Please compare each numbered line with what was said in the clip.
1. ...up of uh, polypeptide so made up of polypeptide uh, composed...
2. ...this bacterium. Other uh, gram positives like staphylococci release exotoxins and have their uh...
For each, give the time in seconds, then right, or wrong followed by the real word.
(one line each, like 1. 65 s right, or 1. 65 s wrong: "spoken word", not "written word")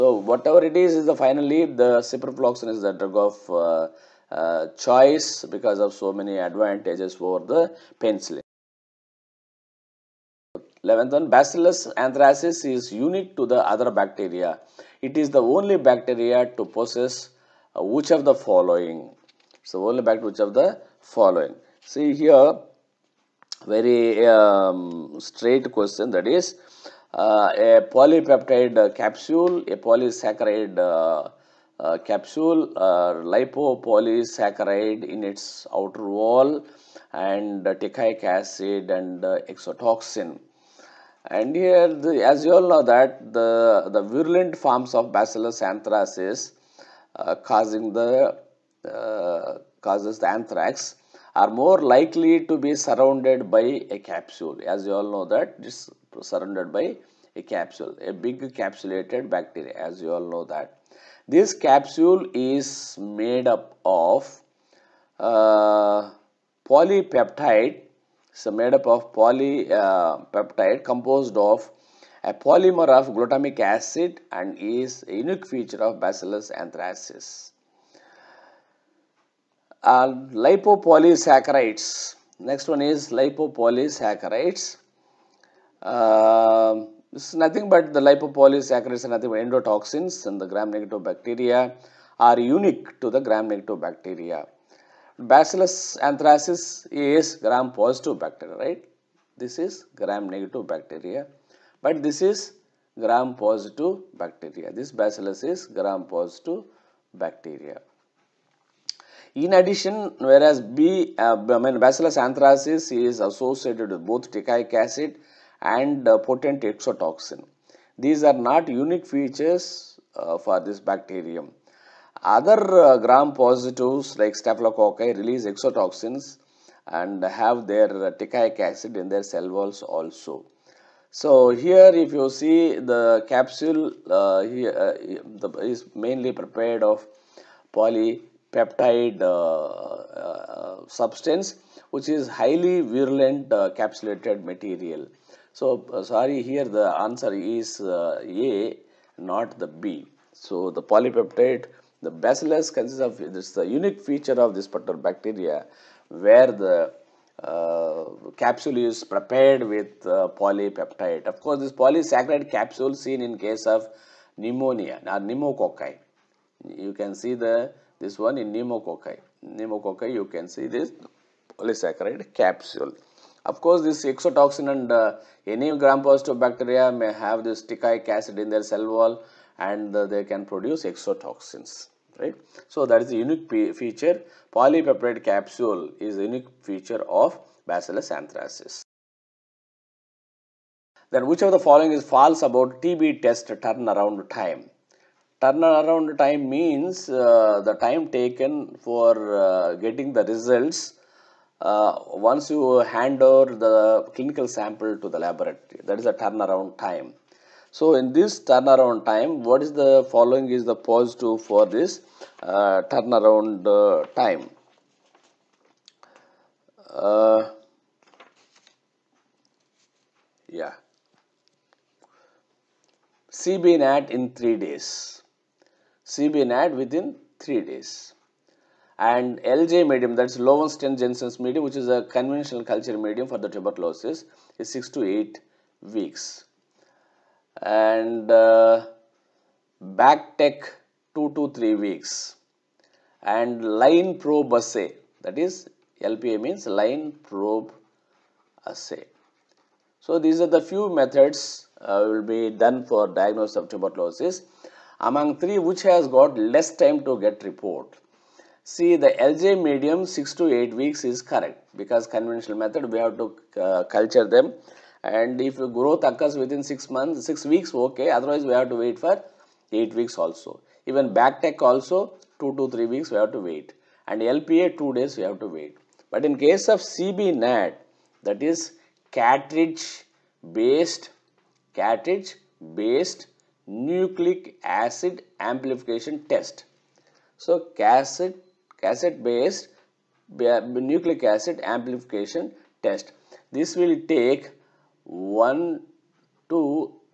1. 63 s right
2. 120 s right.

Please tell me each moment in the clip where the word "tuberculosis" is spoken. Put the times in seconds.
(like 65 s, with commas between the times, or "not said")
233 s, 253 s.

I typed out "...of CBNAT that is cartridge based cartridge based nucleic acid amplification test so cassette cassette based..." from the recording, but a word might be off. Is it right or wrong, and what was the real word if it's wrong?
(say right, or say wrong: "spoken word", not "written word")
right.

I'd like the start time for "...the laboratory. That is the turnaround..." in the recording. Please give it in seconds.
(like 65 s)
205 s.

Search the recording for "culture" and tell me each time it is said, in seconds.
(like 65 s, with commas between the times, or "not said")
232 s, 263 s.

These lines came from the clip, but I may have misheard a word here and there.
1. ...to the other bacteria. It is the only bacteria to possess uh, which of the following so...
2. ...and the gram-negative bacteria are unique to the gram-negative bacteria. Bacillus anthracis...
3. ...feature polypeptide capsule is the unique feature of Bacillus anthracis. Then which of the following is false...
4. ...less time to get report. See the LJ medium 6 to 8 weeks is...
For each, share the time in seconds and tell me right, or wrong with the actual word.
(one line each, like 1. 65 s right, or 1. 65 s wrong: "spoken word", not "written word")
1. 13 s right
2. 90 s right
3. 183 s right
4. 256 s right.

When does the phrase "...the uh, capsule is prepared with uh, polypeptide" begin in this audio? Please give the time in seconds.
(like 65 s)
156 s.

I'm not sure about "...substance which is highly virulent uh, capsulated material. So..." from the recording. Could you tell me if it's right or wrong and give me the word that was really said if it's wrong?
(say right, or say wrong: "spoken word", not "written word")
right.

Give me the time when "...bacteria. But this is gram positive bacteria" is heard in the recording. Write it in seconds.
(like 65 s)
100 s.